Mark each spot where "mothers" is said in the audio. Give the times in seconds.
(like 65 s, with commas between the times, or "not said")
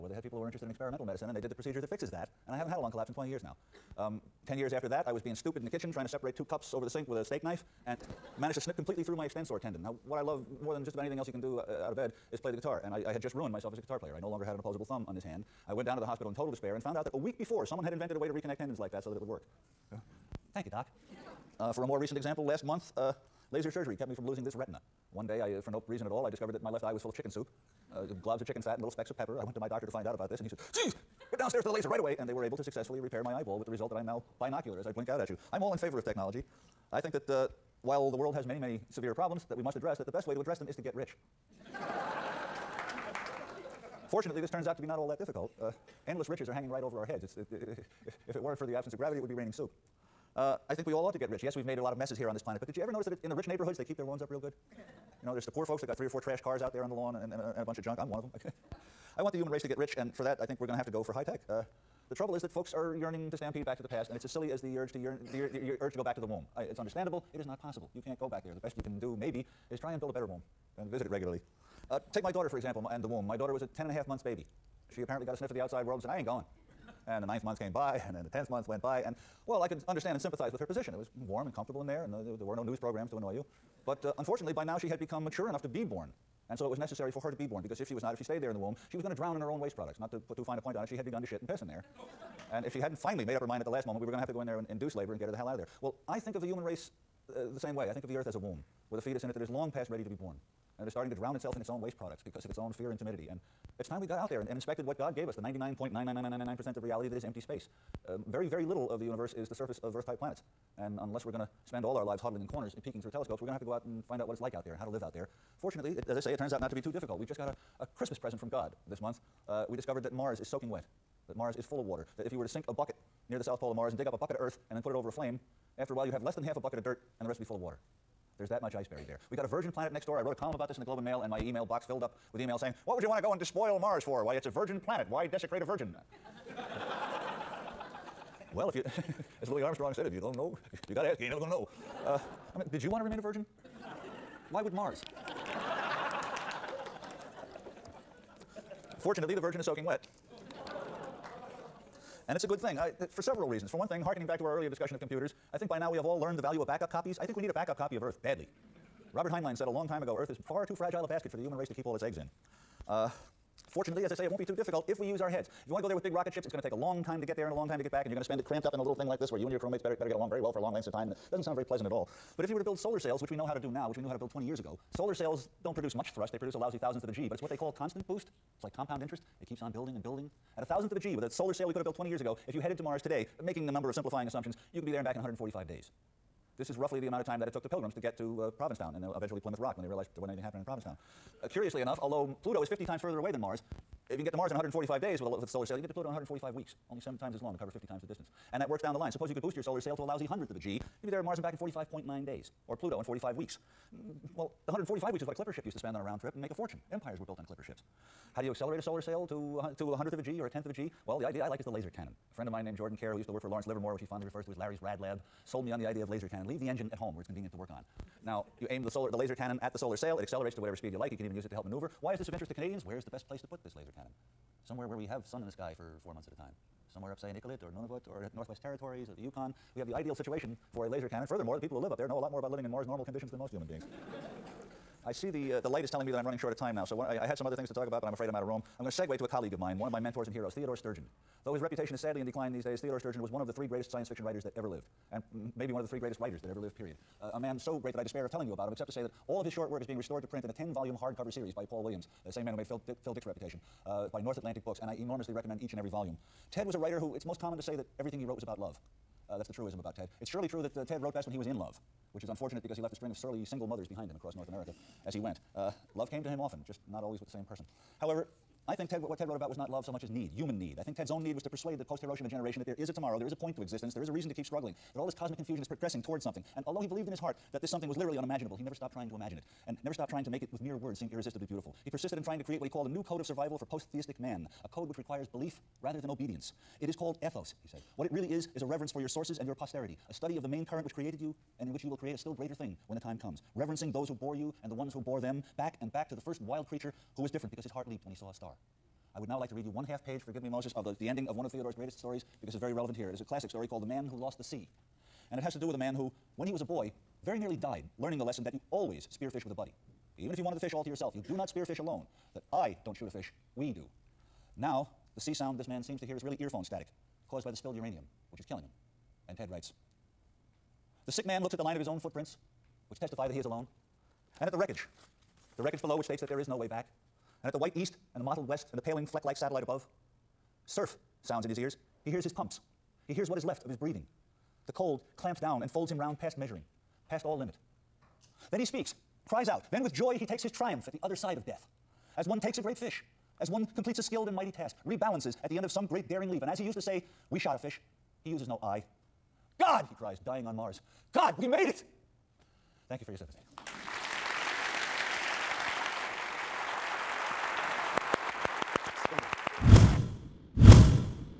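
263 s.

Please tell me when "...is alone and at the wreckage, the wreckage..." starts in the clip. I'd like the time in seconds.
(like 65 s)
323 s.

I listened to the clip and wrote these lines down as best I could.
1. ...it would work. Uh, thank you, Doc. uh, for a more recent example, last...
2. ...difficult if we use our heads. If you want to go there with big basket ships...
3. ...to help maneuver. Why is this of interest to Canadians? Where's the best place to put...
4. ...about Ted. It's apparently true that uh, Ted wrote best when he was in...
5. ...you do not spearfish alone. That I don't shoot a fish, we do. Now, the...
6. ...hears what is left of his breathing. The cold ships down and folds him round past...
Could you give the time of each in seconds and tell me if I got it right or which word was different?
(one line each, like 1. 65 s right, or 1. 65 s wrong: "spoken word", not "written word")
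1. 19 s right
2. 164 s wrong: "rocket", not "basket"
3. 221 s right
4. 259 s wrong: "surely", not "apparently"
5. 311 s right
6. 333 s wrong: "clamps", not "ships".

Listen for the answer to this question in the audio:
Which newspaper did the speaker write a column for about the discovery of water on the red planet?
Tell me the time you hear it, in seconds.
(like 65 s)
130 s.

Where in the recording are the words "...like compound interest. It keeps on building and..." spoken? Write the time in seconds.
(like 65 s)
178 s.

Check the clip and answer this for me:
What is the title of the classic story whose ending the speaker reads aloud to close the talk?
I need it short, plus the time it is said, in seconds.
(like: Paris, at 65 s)
The Man Who Lost the Sea, at 303 s.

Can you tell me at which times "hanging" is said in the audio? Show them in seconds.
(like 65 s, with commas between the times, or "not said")
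46 s.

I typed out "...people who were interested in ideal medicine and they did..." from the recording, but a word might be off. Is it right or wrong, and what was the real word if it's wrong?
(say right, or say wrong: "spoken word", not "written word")
wrong: "experimental", not "ideal".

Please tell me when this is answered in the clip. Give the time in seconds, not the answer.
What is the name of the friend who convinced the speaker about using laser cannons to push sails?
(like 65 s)
212 s.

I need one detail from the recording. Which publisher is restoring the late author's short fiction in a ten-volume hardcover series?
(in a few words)
North Atlantic Books.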